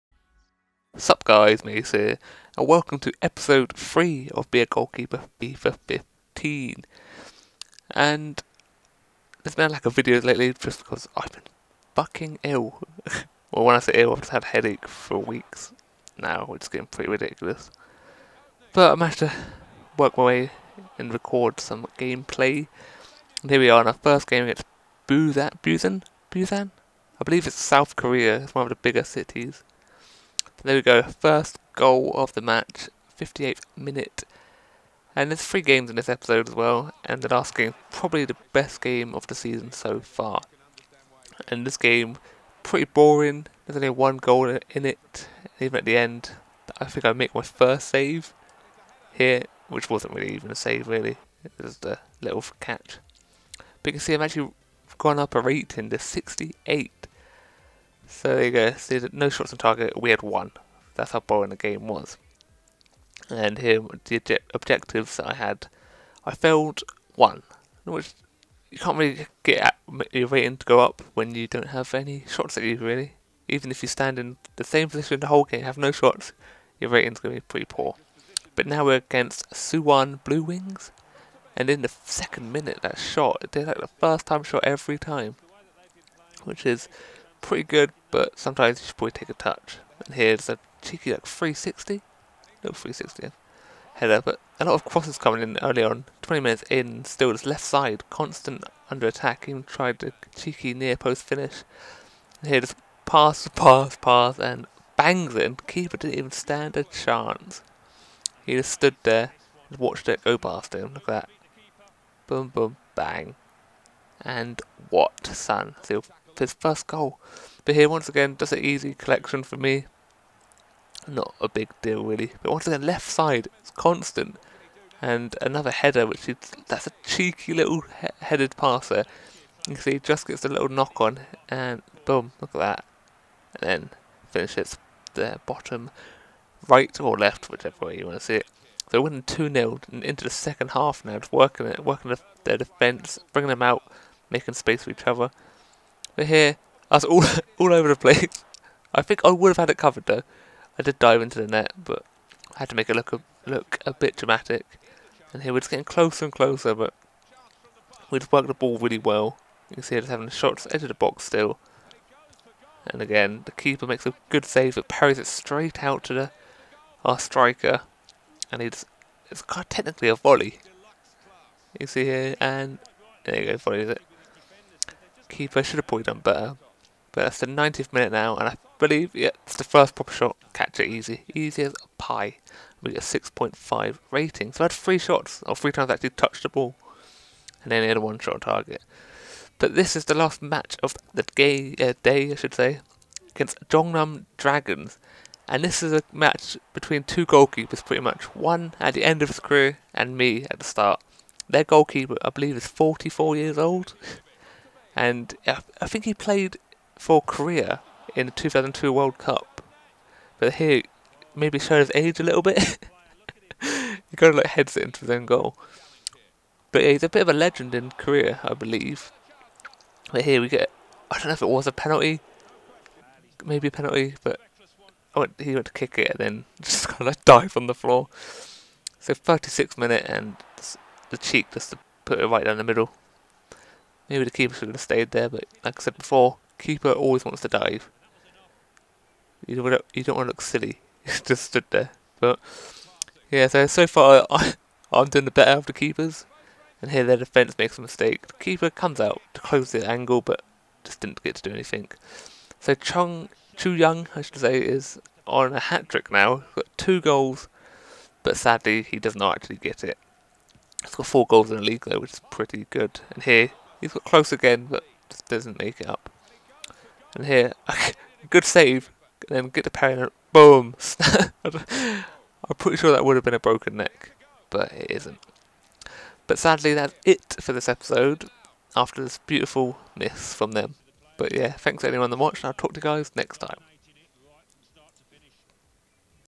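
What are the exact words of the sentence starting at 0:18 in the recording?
But I managed to work my way and record some gameplay.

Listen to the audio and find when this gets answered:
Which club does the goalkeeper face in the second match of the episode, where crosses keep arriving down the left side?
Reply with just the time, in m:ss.
1:19.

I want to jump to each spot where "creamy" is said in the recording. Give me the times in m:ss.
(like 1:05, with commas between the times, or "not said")
not said.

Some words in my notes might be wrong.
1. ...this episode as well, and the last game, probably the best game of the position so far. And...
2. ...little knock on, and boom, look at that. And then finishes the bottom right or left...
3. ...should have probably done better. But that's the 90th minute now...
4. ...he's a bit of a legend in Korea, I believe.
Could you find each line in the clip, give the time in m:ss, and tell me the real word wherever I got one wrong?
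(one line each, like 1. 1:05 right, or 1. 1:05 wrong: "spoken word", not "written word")
1. 0:35 wrong: "season", not "position"
2. 2:10 right
3. 2:55 right
4. 3:36 right.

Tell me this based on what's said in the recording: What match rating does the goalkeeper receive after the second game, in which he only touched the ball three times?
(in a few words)
6.5.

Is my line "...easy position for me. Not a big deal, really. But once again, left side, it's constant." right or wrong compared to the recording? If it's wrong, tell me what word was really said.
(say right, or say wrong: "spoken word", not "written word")
wrong: "collection", not "position".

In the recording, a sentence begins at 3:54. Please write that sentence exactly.
Maybe the keeper should have stayed there, but like I said before, keeper always wants to dive.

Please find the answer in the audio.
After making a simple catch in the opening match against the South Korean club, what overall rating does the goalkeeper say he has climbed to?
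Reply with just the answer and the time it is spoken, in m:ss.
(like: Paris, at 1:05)
68, at 0:55.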